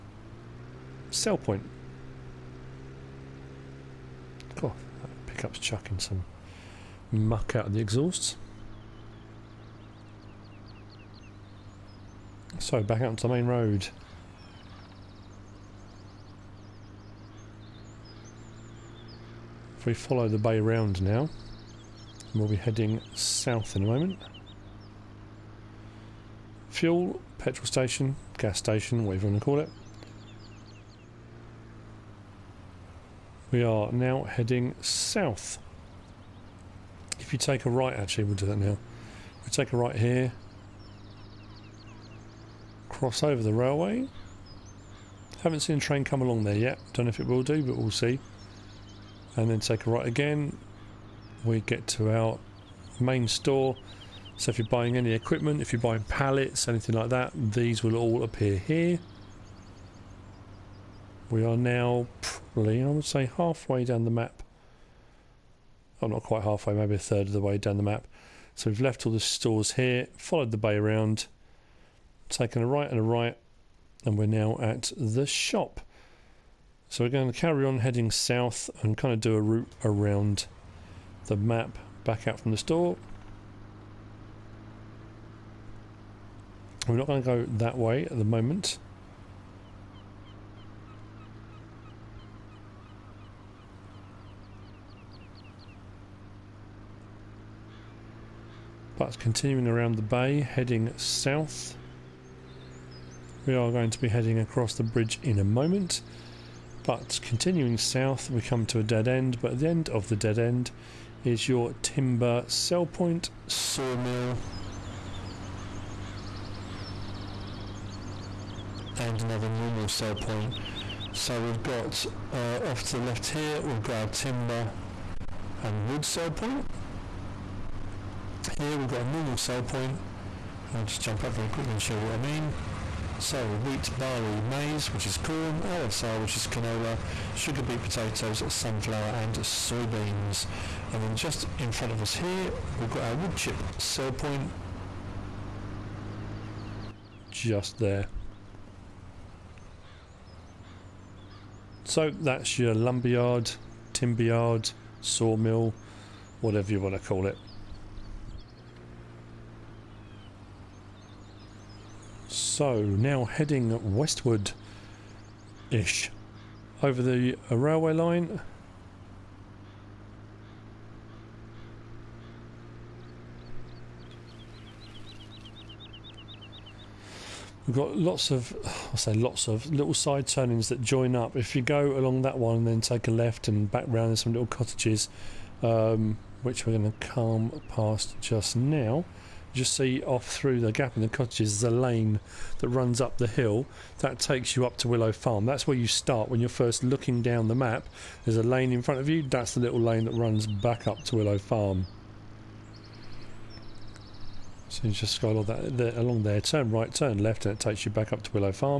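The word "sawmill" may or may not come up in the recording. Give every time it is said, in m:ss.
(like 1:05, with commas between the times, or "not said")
1:53, 2:35.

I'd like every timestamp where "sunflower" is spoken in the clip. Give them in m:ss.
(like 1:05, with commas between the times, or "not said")
2:18.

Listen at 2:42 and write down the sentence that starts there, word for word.
so, now heading westward-ish over the uh, railway line.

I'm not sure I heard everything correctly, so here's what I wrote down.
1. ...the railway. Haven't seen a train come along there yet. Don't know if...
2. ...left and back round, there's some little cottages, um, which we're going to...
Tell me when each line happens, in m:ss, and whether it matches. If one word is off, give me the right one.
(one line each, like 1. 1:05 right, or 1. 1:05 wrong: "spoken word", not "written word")
1. 0:43 right
2. 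3:03 right.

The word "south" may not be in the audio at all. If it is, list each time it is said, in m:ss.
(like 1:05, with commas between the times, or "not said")
0:23, 0:34, 1:18, 1:40, 1:47.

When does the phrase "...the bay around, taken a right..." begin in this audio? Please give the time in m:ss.
1:10.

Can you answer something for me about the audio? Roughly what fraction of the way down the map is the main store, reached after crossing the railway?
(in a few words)
a third.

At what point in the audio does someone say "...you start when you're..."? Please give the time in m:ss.
3:15.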